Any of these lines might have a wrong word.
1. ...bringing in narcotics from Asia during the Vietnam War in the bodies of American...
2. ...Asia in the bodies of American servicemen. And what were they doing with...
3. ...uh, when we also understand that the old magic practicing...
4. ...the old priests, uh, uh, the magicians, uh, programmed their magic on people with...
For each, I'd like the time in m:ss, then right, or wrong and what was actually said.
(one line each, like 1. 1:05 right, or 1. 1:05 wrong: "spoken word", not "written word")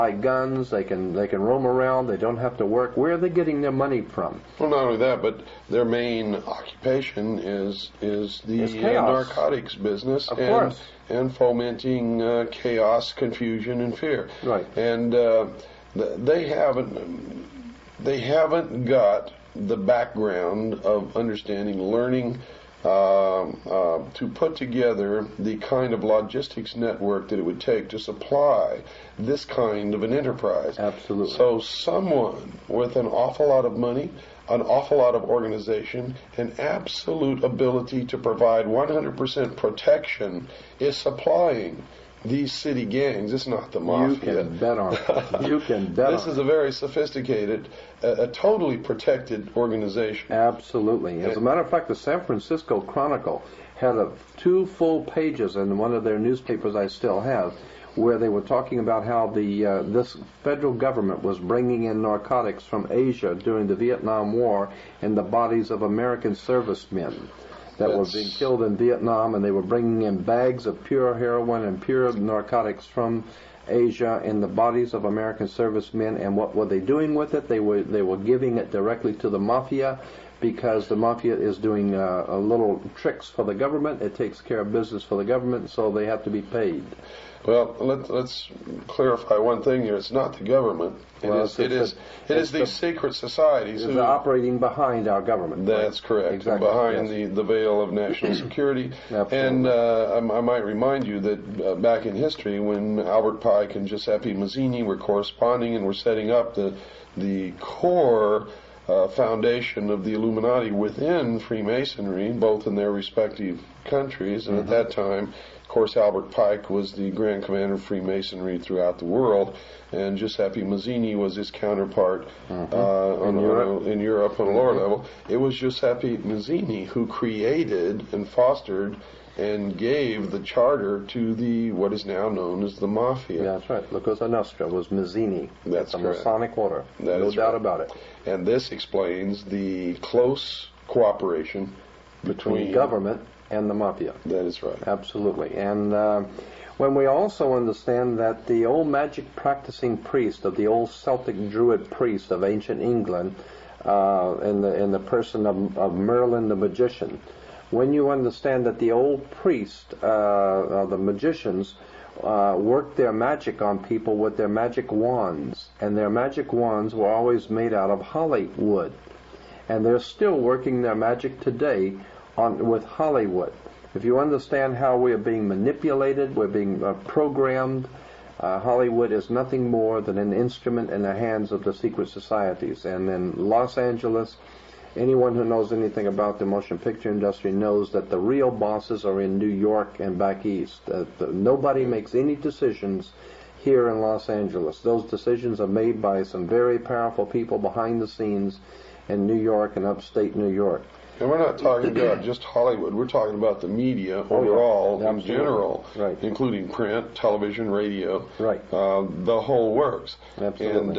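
1. 1:01 right
2. 1:13 right
3. 2:25 right
4. 2:38 wrong: "worked", not "programmed".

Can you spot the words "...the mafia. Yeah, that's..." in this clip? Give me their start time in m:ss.
2:12.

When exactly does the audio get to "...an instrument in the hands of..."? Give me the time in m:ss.
3:00.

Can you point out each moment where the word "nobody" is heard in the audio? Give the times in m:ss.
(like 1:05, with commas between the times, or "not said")
3:11.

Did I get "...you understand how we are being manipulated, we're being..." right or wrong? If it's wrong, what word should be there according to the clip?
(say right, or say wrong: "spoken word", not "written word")
right.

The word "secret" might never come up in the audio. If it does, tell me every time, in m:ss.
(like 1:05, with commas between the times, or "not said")
1:32, 3:01.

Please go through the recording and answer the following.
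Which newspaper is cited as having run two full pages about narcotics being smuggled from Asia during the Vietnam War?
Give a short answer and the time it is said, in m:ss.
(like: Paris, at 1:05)
San Francisco Chronicle, at 0:51.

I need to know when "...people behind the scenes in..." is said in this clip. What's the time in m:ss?
3:17.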